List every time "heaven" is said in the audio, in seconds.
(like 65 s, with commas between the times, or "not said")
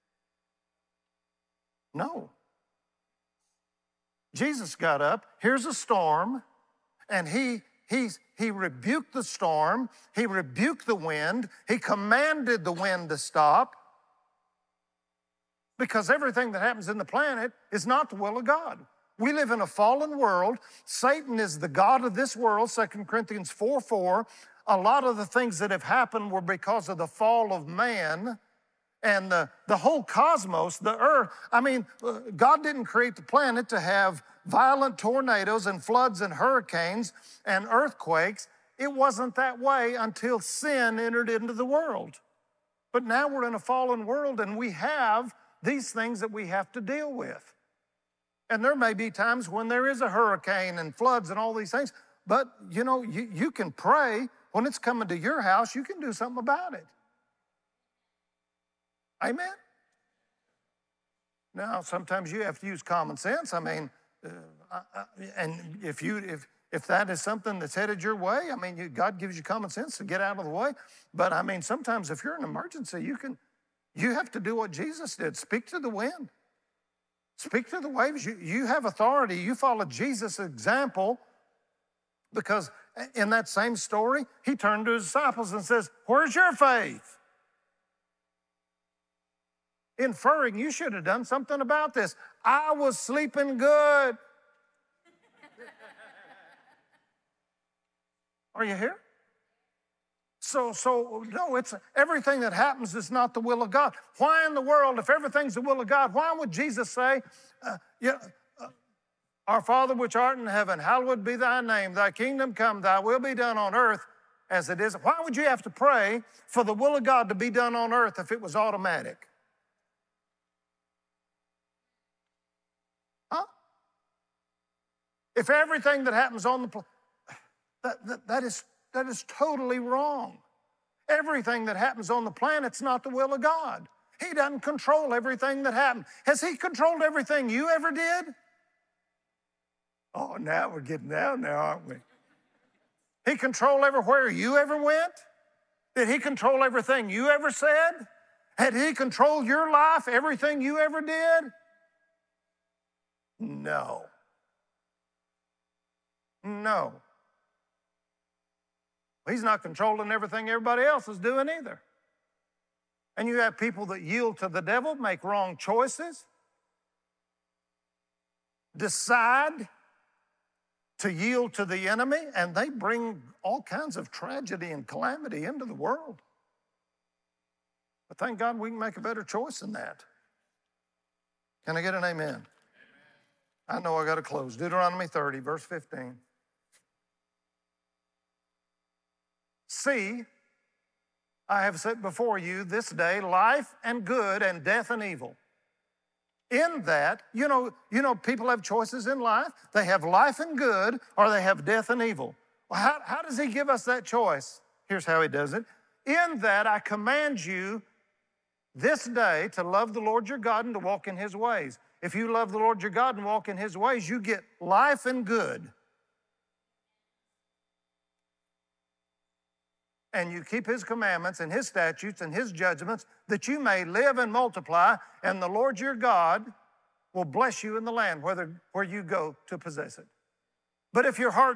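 110 s.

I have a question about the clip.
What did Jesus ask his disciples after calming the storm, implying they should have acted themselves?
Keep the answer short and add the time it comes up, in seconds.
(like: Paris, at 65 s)
Where's your faith?, at 86 s.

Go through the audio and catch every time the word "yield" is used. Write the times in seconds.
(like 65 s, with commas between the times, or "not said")
164 s, 171 s.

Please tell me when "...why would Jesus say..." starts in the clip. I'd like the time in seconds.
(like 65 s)
106 s.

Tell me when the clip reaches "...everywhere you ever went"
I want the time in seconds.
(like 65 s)
143 s.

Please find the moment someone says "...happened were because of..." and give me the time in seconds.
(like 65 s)
25 s.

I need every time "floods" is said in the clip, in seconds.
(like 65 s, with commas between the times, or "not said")
35 s, 50 s.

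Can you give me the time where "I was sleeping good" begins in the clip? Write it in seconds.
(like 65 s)
92 s.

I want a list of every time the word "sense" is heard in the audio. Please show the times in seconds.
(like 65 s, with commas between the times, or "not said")
63 s, 69 s.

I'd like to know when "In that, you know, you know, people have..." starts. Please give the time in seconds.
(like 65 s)
196 s.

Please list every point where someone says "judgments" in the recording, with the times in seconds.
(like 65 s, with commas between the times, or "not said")
222 s.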